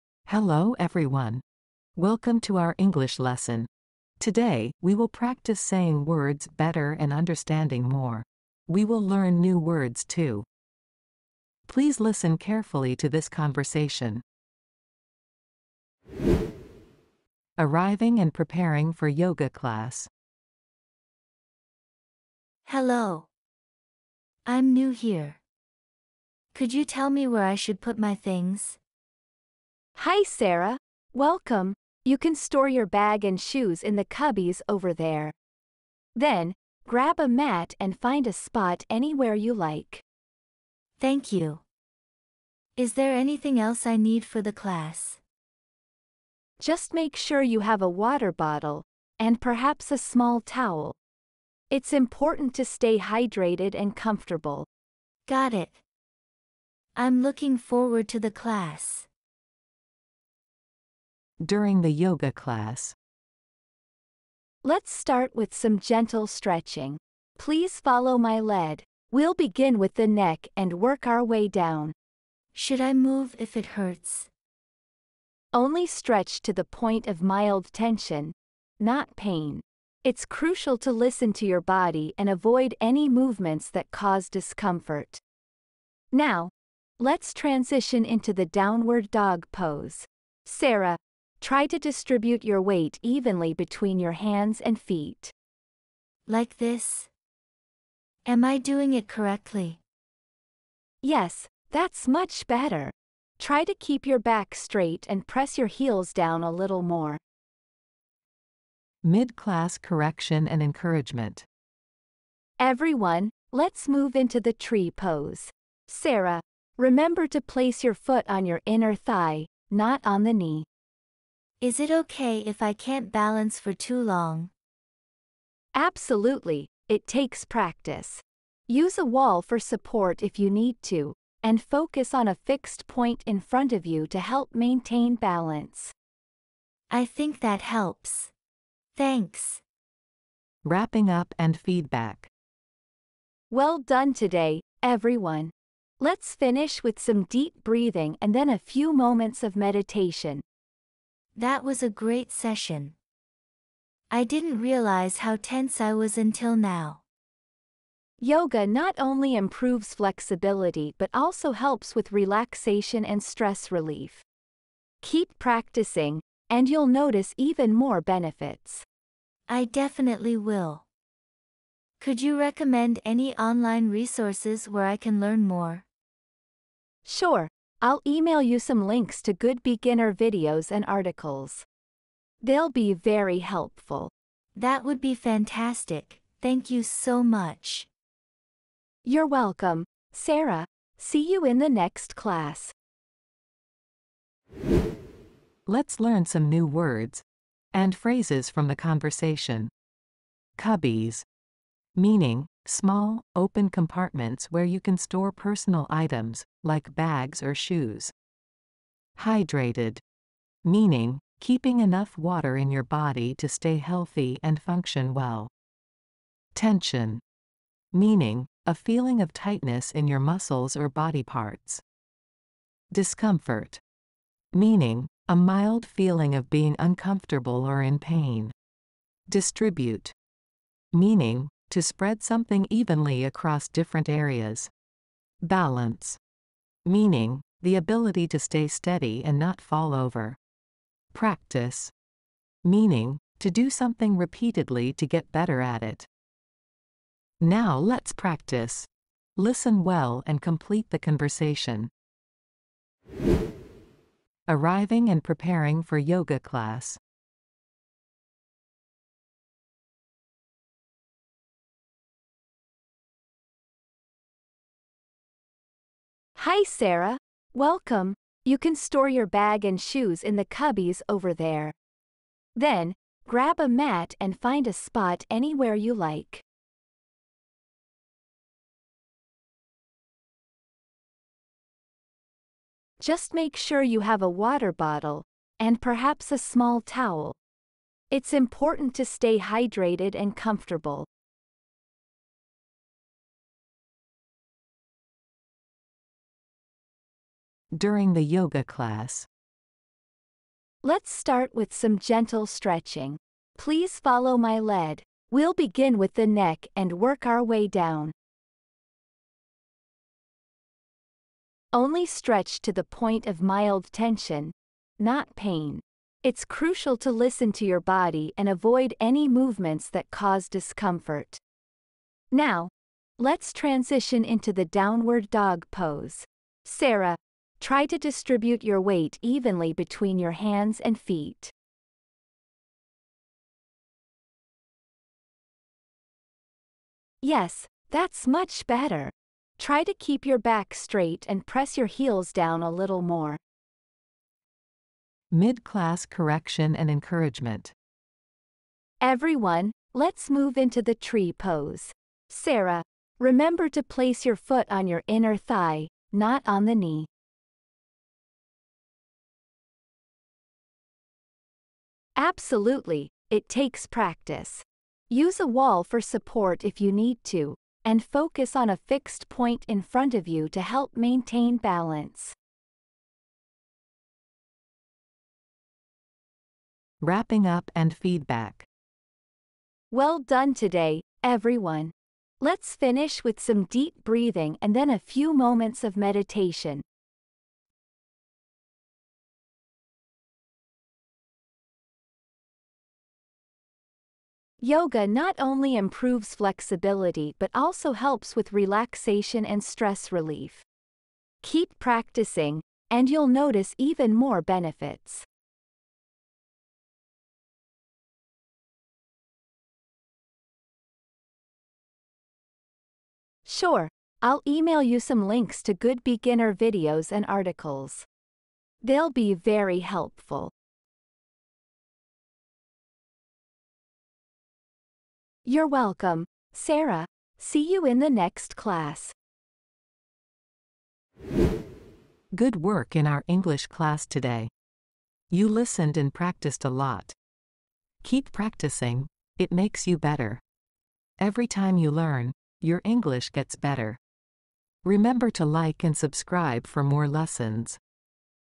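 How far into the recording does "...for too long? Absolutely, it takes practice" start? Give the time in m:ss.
2:03.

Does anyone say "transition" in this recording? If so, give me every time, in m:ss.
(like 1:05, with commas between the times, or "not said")
1:27, 5:23.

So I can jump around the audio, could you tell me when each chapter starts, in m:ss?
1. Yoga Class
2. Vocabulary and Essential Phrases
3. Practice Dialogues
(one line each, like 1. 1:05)
1. 0:18
2. 3:21
3. 4:19.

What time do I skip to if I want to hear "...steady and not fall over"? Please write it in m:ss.
3:58.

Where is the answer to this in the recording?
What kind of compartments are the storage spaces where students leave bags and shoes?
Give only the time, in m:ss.
3:22.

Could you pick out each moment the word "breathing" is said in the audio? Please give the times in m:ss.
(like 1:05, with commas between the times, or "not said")
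2:27, 6:24.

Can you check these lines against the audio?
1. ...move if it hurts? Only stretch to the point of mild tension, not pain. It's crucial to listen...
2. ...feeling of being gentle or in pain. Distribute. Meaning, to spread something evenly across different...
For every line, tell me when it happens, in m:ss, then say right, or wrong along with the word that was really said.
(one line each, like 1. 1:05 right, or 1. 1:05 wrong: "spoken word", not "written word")
1. 1:12 right
2. 3:45 wrong: "uncomfortable", not "gentle".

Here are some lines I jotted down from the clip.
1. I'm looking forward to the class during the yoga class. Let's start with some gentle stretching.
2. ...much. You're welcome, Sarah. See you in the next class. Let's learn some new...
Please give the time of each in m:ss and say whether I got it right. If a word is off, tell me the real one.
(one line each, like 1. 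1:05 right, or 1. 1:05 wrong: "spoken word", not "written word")
1. 0:56 right
2. 3:07 right.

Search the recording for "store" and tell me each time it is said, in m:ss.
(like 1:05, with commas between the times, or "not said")
0:32, 3:24, 4:28.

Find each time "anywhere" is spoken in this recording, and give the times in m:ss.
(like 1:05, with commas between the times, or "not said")
0:38, 4:35.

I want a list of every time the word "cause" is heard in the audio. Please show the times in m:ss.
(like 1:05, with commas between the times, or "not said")
1:23, 5:20.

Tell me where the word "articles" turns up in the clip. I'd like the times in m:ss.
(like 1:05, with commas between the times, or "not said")
3:00, 6:57.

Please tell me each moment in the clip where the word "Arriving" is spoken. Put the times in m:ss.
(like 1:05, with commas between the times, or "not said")
0:17, 4:14.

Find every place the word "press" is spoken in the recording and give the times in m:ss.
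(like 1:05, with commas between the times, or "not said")
1:45, 5:41.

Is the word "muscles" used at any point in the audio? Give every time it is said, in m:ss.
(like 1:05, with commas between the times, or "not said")
3:40.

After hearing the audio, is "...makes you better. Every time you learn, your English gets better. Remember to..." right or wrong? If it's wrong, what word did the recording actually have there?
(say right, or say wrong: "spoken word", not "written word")
right.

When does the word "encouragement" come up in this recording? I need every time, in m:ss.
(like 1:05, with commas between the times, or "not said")
1:50, 5:46.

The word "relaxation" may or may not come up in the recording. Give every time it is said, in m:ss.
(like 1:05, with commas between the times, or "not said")
2:42, 6:38.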